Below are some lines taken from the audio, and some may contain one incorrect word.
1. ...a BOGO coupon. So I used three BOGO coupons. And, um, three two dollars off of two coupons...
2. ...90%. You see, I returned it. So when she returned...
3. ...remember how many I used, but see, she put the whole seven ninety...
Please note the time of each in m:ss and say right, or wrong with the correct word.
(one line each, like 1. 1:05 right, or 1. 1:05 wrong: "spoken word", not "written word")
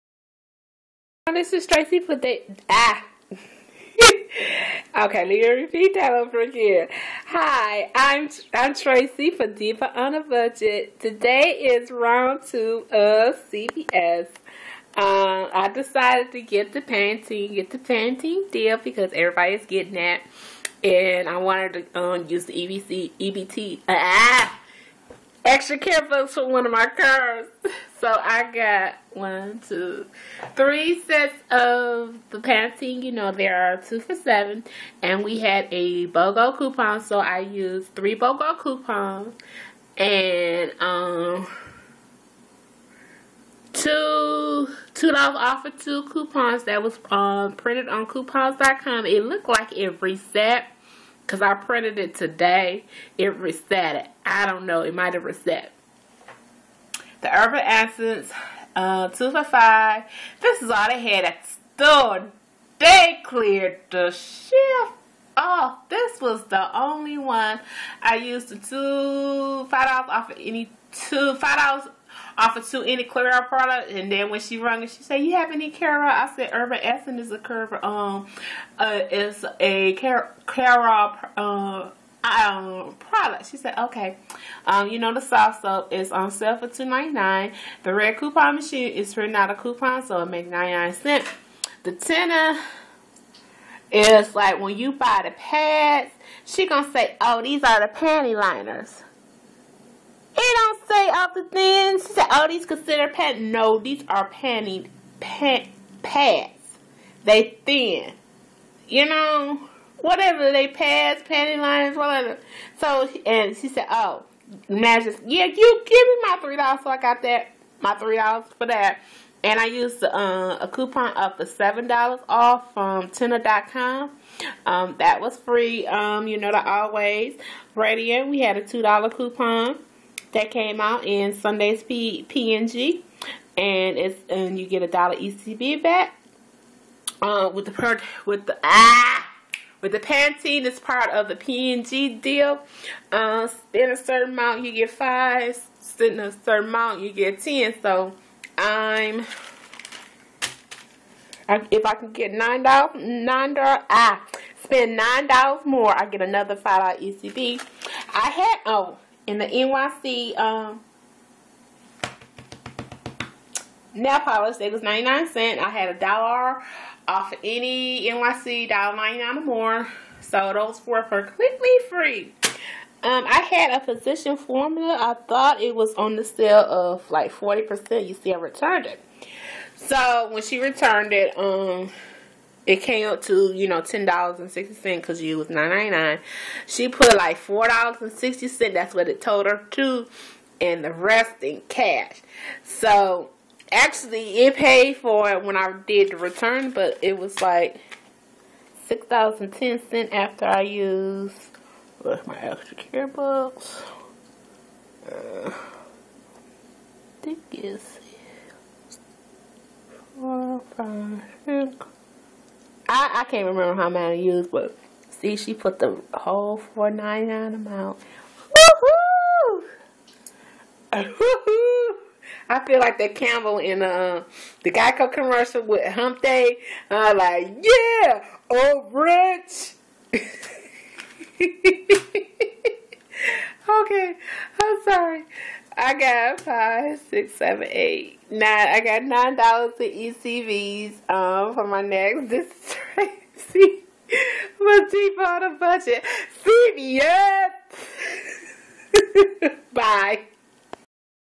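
1. 0:35 wrong: "two", not "three"
2. 2:57 wrong: "40", not "90"
3. 3:33 wrong: "four", not "seven".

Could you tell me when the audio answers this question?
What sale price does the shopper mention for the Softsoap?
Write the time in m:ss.
1:26.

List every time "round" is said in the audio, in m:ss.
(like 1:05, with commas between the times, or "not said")
0:11.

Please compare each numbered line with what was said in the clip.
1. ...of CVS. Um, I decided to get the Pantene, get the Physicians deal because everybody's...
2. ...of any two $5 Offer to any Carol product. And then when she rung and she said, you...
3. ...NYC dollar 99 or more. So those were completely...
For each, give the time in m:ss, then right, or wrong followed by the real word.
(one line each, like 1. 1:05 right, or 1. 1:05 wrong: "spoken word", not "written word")
1. 0:12 wrong: "Pantene", not "Physicians"
2. 1:10 right
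3. 2:48 right.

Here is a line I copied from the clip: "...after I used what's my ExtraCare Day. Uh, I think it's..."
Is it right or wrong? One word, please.
wrong.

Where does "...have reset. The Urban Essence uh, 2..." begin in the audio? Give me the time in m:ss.
0:55.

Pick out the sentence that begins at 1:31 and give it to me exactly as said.
The Tena is like when you buy the pads, she gonna say, oh, these are the panty liners.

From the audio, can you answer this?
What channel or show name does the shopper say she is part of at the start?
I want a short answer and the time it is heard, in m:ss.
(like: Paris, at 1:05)
Diva on a Budget, at 0:09.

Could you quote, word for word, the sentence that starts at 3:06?
She put like four dollars and sixty cent.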